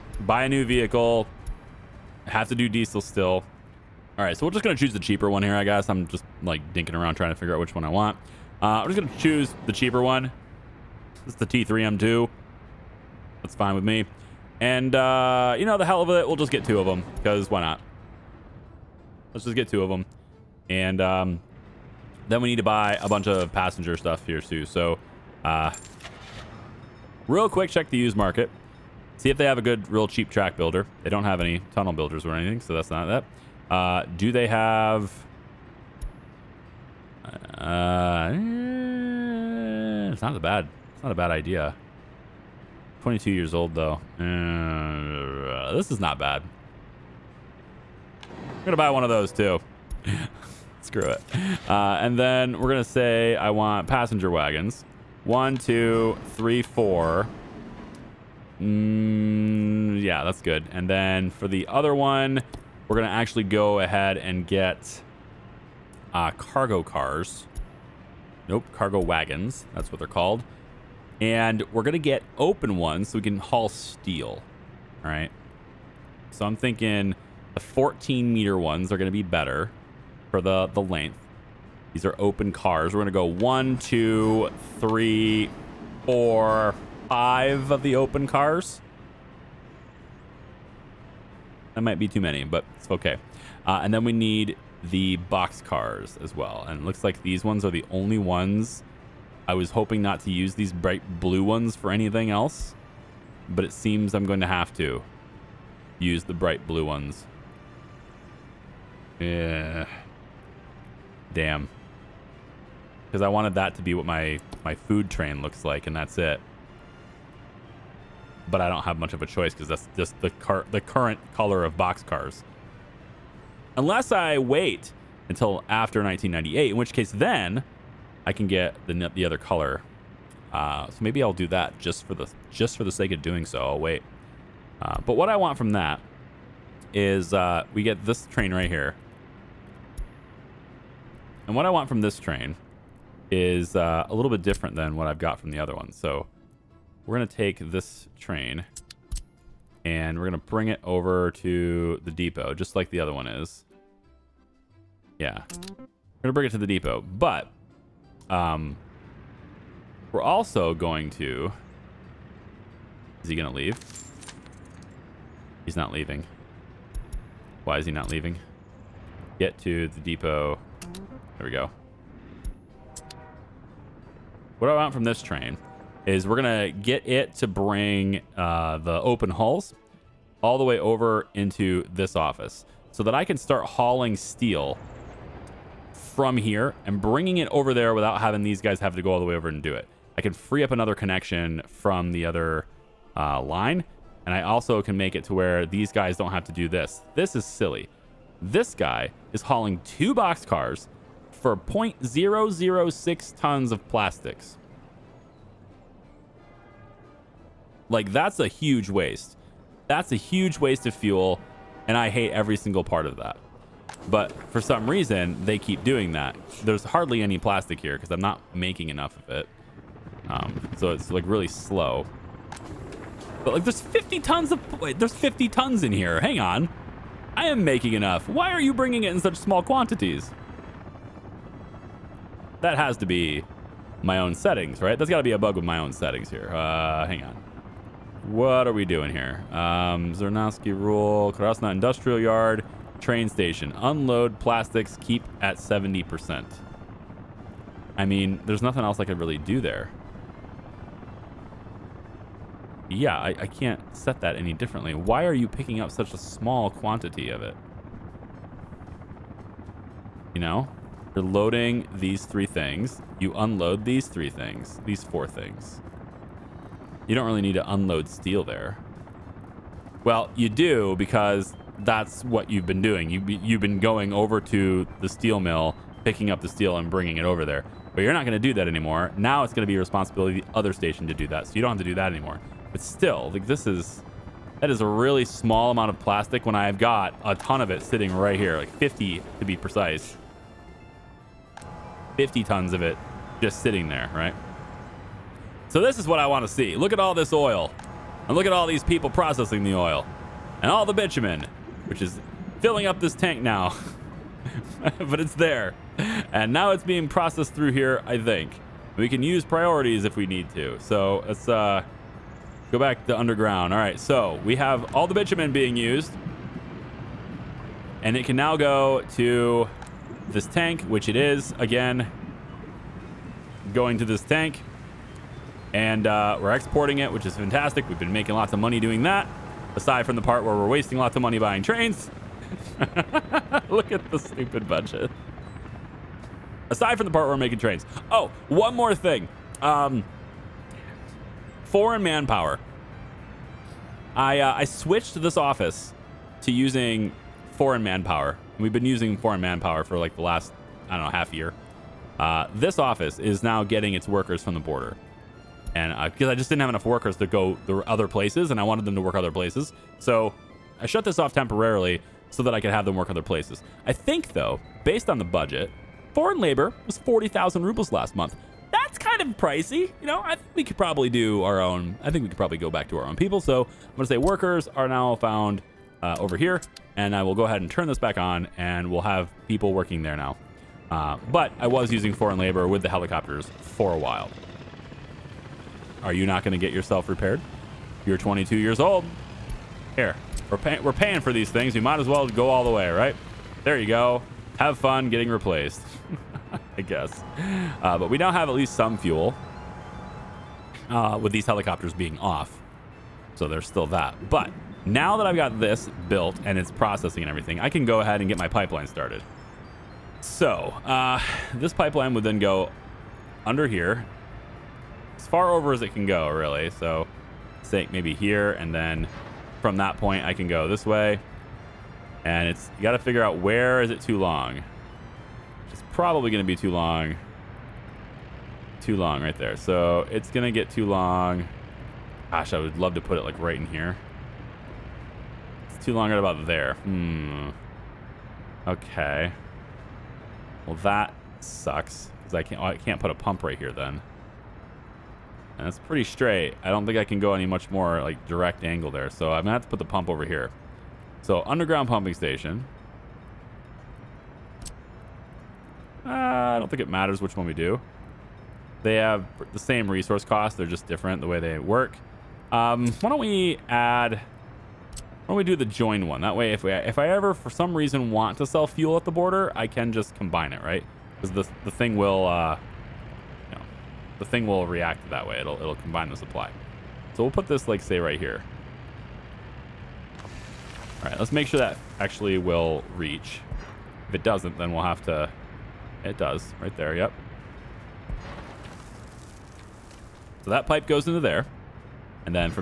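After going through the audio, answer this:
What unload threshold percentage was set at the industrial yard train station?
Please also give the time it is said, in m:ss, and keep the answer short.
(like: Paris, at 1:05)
70%, at 4:05.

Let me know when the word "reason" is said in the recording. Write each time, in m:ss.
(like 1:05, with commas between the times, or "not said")
3:34, 7:47.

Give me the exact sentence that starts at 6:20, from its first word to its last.
Uh, but I was using foreign labor with the helicopters for a while.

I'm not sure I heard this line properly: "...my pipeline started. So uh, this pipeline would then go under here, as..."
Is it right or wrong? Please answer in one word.
right.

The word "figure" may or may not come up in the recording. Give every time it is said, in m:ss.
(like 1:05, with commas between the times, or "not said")
0:07, 7:02.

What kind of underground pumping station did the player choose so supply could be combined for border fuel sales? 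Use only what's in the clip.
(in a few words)
join.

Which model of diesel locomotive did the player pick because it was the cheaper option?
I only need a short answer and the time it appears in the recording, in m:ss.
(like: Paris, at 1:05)
T3M2, at 0:11.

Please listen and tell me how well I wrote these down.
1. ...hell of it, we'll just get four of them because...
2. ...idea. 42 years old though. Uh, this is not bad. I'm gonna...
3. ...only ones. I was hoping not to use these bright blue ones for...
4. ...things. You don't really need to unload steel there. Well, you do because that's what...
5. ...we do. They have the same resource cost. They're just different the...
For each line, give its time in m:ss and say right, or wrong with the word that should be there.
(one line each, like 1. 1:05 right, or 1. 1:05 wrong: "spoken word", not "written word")
1. 0:15 wrong: "two", not "four"
2. 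0:41 wrong: "22", not "42"
3. 1:37 right
4. 4:25 right
5. 7:37 right.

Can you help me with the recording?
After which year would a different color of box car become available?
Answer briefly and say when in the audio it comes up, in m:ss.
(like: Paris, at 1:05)
1998, at 2:06.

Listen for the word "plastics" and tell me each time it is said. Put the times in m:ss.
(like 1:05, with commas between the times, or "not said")
3:23, 3:37, 4:04, 4:45.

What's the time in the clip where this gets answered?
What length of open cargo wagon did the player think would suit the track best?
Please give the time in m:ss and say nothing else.
1:17.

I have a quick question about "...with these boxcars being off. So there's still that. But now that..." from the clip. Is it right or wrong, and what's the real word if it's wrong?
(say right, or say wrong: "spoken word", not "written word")
wrong: "helicopters", not "boxcars".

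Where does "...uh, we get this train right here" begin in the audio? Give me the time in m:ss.
2:17.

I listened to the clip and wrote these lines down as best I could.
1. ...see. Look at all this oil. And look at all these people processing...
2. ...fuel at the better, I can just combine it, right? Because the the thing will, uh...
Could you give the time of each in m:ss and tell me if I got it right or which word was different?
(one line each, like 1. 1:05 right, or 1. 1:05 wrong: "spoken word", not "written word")
1. 4:56 right
2. 7:48 wrong: "border", not "better".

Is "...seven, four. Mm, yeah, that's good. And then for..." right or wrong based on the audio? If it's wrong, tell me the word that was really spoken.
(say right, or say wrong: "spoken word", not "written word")
wrong: "three", not "seven".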